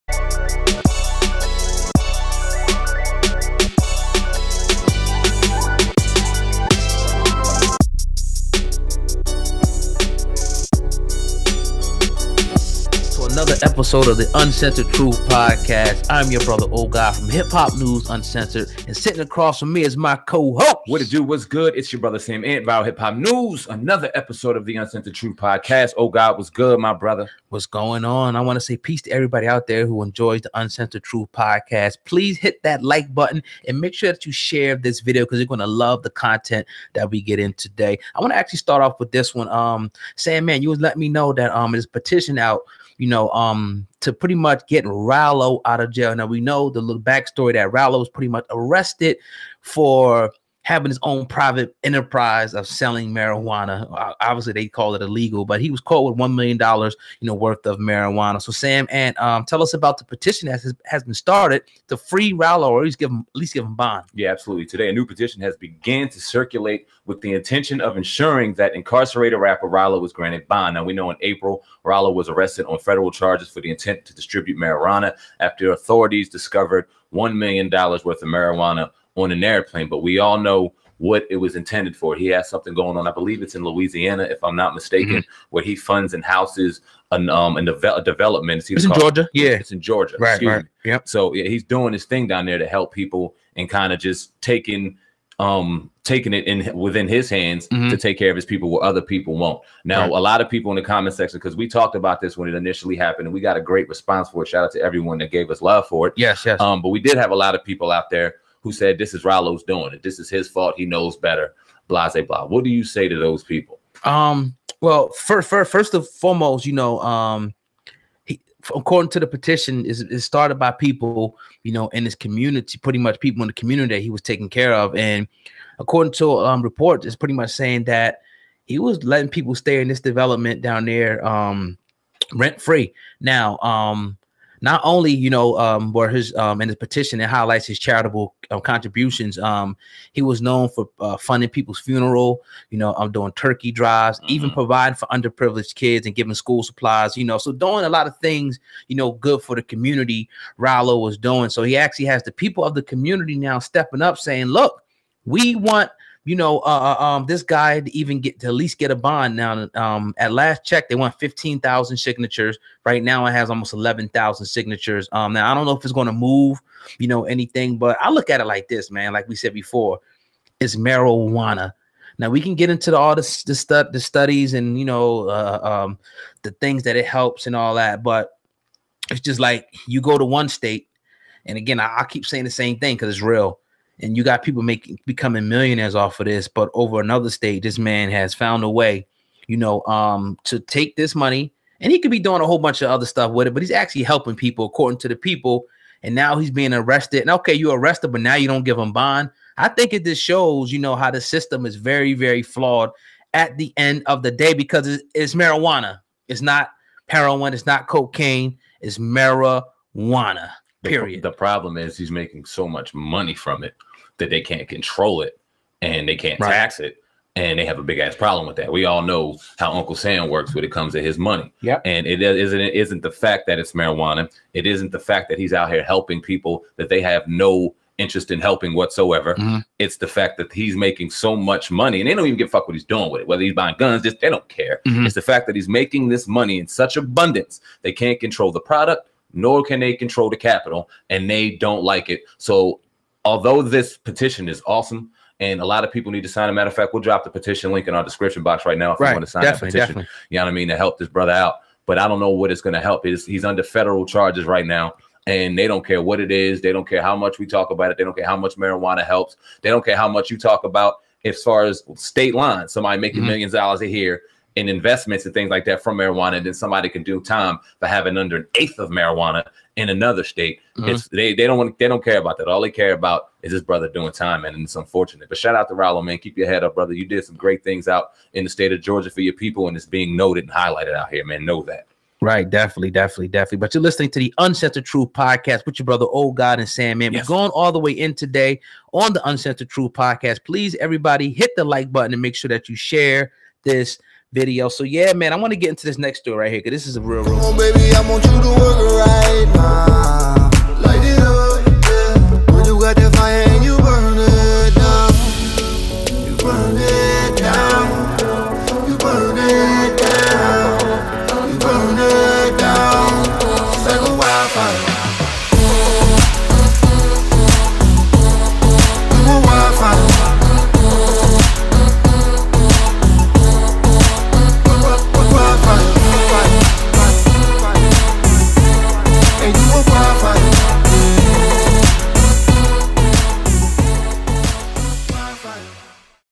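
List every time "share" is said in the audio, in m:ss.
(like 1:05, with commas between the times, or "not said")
0:34, 4:52.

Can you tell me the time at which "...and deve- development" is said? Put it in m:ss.
1:27.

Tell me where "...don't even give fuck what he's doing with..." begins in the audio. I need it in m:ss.
3:52.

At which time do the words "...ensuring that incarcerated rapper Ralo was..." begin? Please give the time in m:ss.
1:07.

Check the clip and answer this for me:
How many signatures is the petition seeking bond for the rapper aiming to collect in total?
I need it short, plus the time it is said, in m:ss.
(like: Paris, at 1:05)
15,000, at 2:41.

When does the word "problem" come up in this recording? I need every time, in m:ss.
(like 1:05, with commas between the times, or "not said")
3:31, 3:38.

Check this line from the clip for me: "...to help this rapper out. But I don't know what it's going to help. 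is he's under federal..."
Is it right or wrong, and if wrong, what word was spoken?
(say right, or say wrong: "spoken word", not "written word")
wrong: "brother", not "rapper".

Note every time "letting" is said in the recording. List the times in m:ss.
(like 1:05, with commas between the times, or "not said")
0:40, 2:09.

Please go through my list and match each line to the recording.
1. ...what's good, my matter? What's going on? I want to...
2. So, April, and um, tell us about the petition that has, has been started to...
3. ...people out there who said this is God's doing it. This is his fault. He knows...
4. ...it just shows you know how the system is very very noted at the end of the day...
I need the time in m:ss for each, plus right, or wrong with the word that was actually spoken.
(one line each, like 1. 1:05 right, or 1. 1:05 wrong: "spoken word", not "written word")
1. 0:26 wrong: "brother", not "matter"
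2. 0:58 wrong: "Sam", not "April"
3. 1:47 wrong: "Ralo", not "God"
4. 3:19 wrong: "flawed", not "noted".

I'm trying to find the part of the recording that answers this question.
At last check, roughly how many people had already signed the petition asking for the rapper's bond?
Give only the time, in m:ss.
2:43.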